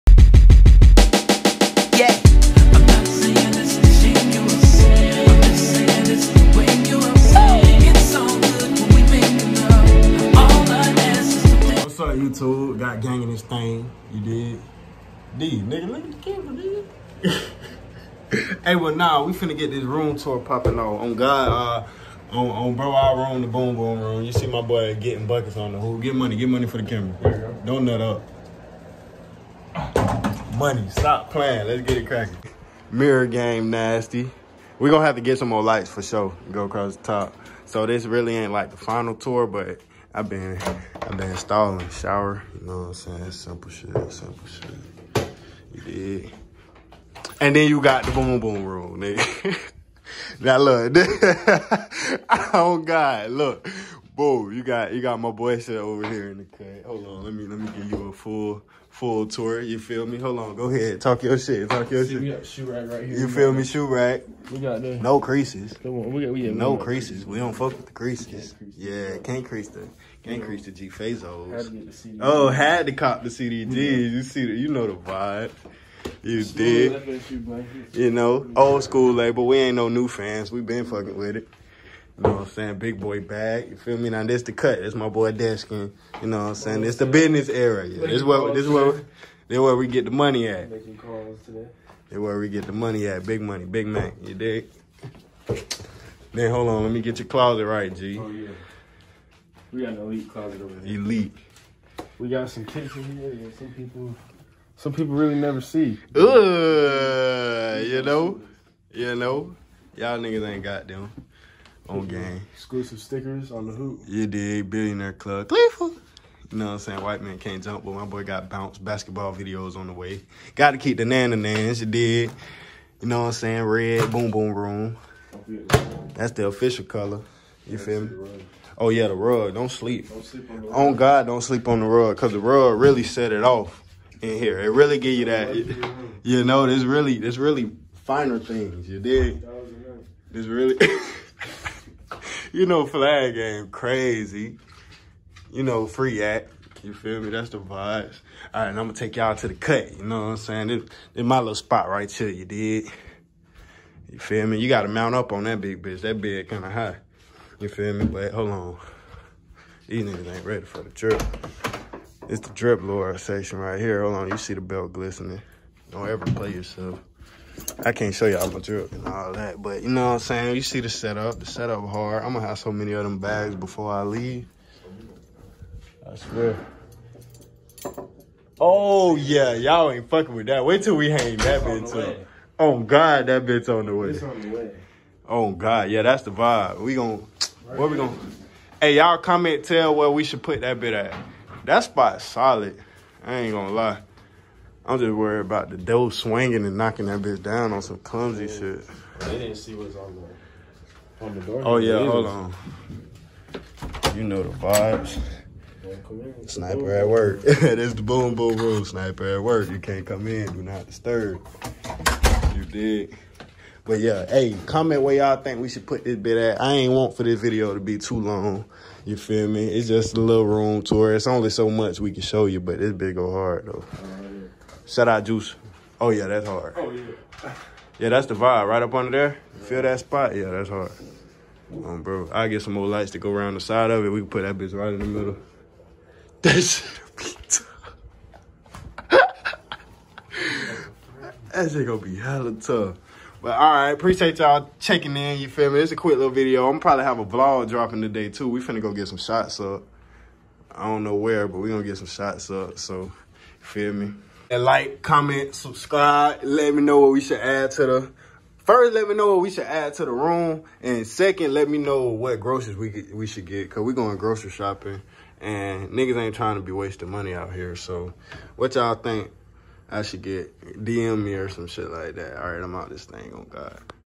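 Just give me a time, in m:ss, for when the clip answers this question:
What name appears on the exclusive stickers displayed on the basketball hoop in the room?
1:54.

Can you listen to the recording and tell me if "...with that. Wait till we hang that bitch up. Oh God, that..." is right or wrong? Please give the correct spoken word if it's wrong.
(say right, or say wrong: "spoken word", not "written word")
right.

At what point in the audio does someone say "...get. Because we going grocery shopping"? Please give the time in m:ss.
4:23.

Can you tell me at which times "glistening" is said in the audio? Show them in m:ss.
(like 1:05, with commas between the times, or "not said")
2:44.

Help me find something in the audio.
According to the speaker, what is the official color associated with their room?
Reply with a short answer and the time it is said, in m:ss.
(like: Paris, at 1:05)
Red, at 2:03.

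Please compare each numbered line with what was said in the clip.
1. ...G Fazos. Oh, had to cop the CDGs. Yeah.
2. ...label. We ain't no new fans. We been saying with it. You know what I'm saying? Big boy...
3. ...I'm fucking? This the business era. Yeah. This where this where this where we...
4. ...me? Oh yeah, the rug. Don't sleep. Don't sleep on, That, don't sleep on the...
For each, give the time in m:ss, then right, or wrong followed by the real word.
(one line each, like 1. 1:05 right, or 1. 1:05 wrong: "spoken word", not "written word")
1. 1:10 right
2. 1:19 wrong: "fucking", not "saying"
3. 1:26 wrong: "saying", not "fucking"
4. 2:08 wrong: "God", not "That".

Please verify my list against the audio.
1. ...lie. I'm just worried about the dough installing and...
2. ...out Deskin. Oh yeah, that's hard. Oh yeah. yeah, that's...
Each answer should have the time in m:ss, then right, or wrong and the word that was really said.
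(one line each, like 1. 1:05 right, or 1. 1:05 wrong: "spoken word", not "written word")
1. 3:13 wrong: "swinging", not "installing"
2. 3:45 wrong: "Juice", not "Deskin".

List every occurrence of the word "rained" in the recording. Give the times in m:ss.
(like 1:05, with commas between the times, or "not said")
not said.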